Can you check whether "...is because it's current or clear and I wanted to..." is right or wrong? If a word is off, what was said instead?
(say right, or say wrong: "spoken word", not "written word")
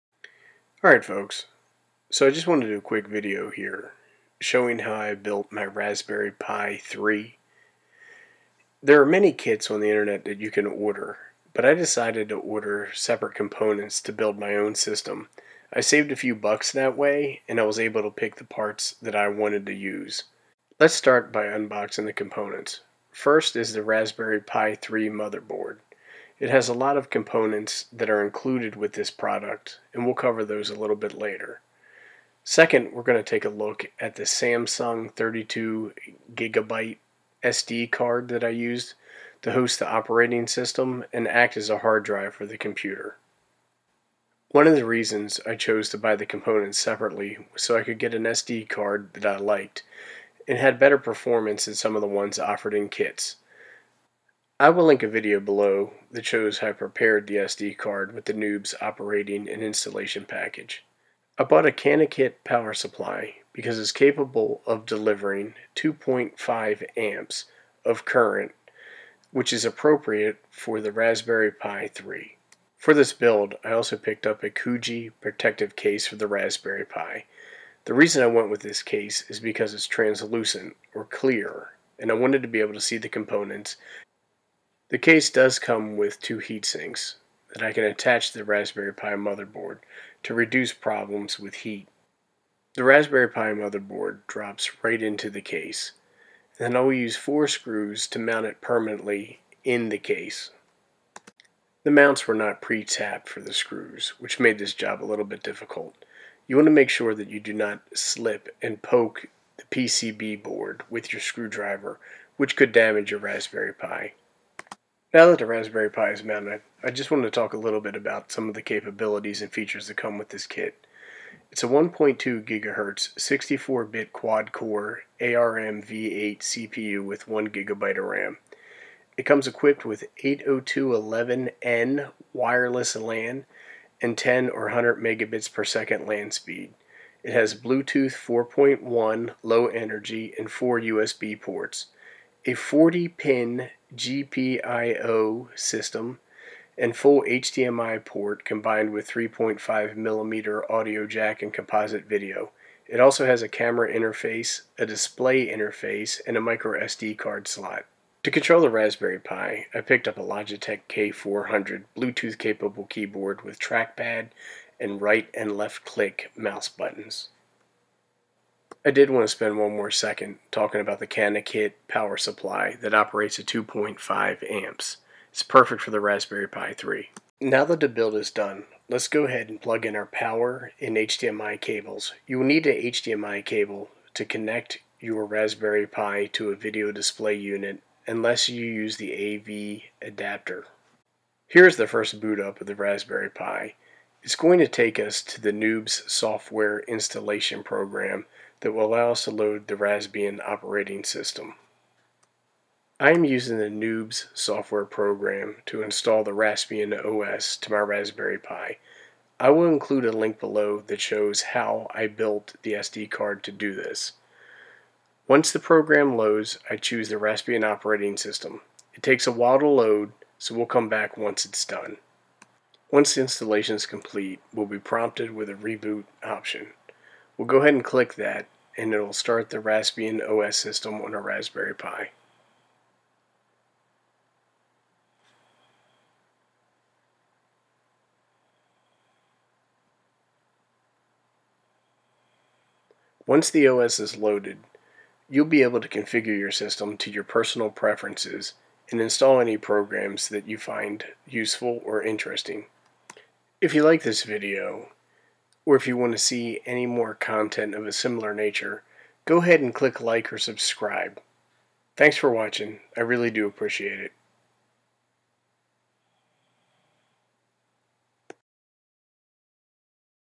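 wrong: "translucent", not "current".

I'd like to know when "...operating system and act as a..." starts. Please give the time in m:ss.
0:39.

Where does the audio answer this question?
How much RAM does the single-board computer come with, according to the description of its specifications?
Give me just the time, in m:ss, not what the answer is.
2:07.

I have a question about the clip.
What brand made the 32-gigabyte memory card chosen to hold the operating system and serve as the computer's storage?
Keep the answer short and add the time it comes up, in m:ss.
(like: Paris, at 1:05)
Samsung, at 0:34.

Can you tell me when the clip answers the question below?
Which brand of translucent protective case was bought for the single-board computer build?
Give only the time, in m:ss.
1:14.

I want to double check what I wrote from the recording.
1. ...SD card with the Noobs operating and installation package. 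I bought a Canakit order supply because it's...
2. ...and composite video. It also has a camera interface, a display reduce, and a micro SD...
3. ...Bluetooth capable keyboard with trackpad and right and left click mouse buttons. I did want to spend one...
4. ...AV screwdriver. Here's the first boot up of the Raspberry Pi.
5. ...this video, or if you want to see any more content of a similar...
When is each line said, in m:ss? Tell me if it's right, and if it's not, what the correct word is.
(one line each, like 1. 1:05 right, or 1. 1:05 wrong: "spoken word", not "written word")
1. 0:57 wrong: "power", not "order"
2. 2:31 wrong: "interface", not "reduce"
3. 2:41 right
4. 3:09 wrong: "adapter", not "screwdriver"
5. 4:14 right.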